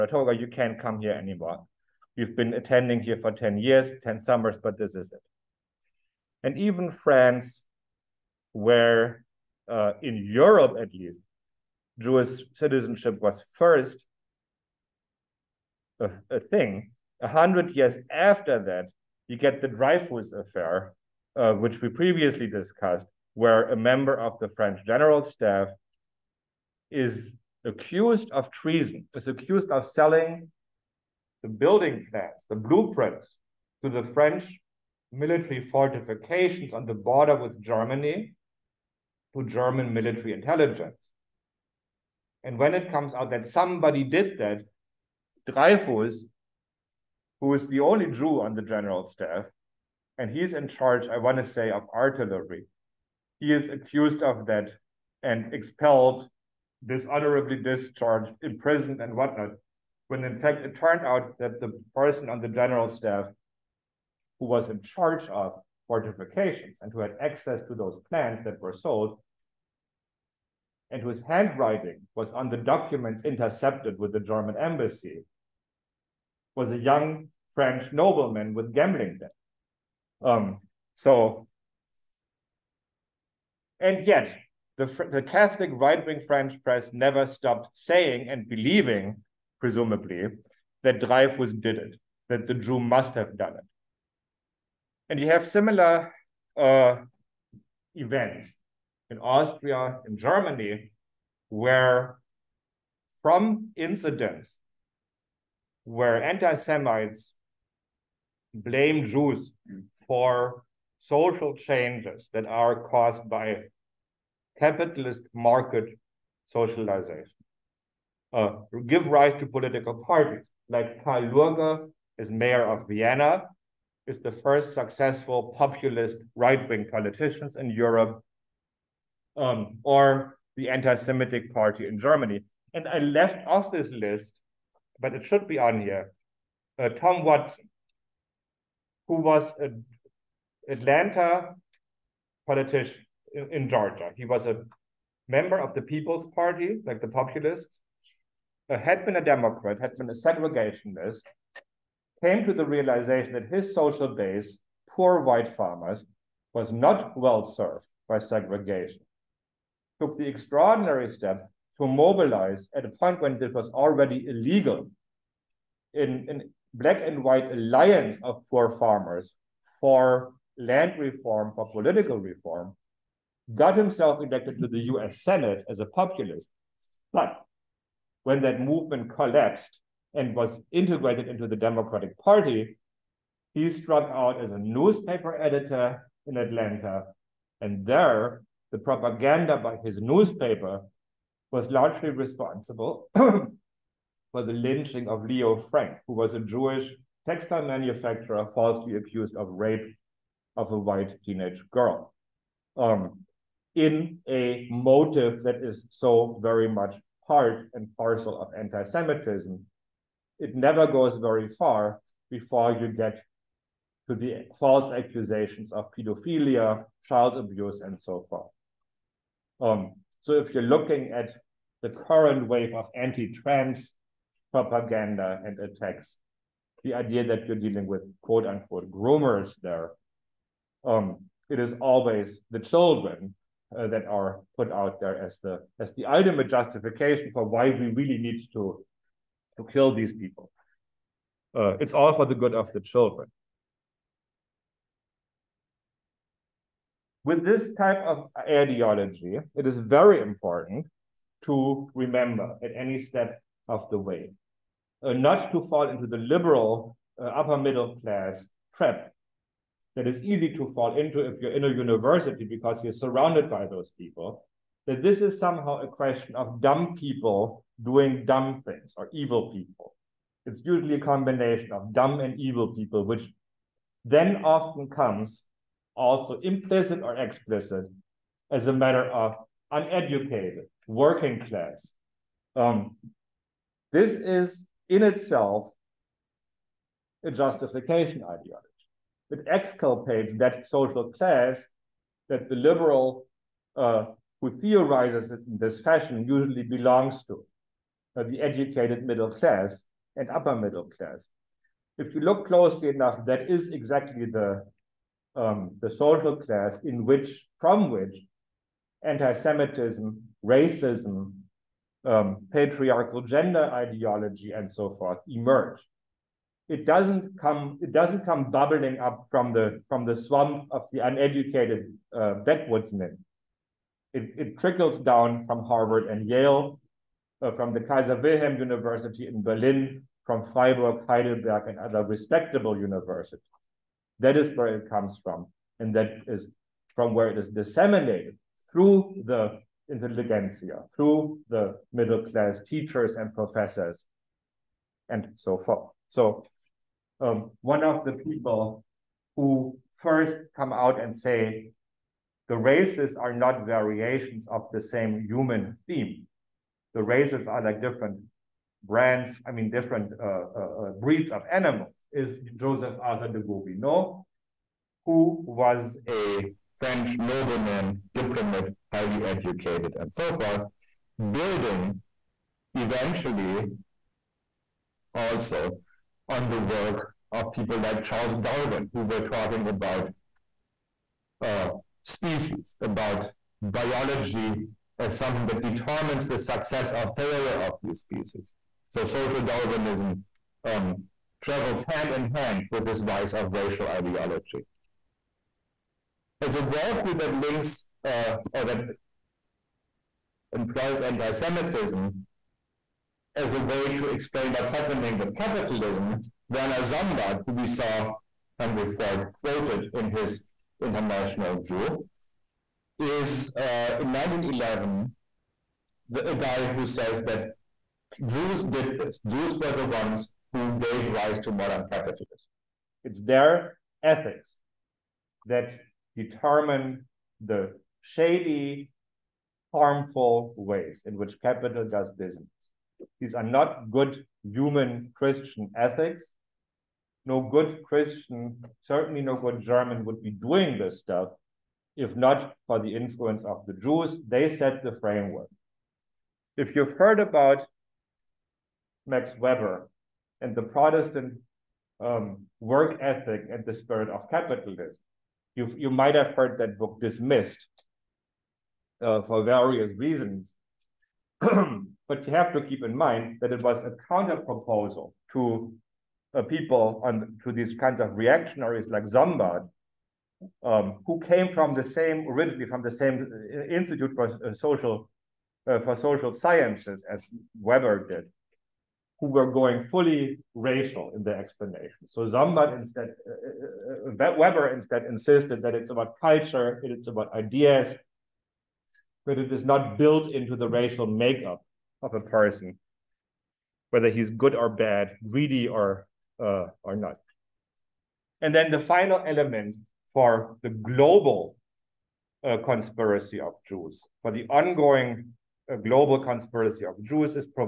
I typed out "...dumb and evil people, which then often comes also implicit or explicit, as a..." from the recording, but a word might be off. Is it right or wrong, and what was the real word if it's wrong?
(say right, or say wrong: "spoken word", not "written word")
right.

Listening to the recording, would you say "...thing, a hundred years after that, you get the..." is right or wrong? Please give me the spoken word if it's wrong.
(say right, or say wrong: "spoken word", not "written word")
right.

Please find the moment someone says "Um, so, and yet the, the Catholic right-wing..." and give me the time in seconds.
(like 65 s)
80 s.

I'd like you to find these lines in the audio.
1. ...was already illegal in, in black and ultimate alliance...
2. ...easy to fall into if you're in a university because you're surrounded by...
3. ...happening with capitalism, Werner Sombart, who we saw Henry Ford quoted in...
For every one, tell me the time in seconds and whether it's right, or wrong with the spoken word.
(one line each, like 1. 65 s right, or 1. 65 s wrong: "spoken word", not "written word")
1. 163 s wrong: "white", not "ultimate"
2. 260 s right
3. 404 s right.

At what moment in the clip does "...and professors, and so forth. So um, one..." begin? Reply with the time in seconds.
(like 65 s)
343 s.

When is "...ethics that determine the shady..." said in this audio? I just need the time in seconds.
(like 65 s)
424 s.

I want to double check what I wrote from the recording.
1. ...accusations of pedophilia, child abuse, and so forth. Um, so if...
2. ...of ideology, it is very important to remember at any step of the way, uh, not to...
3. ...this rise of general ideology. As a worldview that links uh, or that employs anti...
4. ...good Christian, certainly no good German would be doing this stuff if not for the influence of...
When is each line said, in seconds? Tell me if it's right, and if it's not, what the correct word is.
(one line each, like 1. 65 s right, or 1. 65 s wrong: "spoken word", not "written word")
1. 214 s right
2. 247 s right
3. 392 s wrong: "racial", not "general"
4. 437 s right.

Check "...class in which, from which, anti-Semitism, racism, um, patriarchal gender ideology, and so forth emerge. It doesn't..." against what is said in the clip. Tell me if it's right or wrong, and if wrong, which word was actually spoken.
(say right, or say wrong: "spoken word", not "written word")
right.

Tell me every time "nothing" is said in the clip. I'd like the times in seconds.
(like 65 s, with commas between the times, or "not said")
not said.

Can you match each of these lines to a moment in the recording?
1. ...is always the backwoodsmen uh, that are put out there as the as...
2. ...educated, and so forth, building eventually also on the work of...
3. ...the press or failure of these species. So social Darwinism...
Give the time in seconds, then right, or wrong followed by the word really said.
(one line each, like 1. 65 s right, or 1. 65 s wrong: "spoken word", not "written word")
1. 231 s wrong: "children", not "backwoodsmen"
2. 369 s right
3. 386 s wrong: "success", not "press".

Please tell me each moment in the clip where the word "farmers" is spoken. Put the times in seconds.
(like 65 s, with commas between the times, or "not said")
155 s, 168 s.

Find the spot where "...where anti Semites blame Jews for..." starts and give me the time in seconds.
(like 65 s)
105 s.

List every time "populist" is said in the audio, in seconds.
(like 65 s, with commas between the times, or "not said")
125 s, 147 s, 175 s.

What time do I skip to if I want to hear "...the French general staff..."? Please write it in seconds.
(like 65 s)
24 s.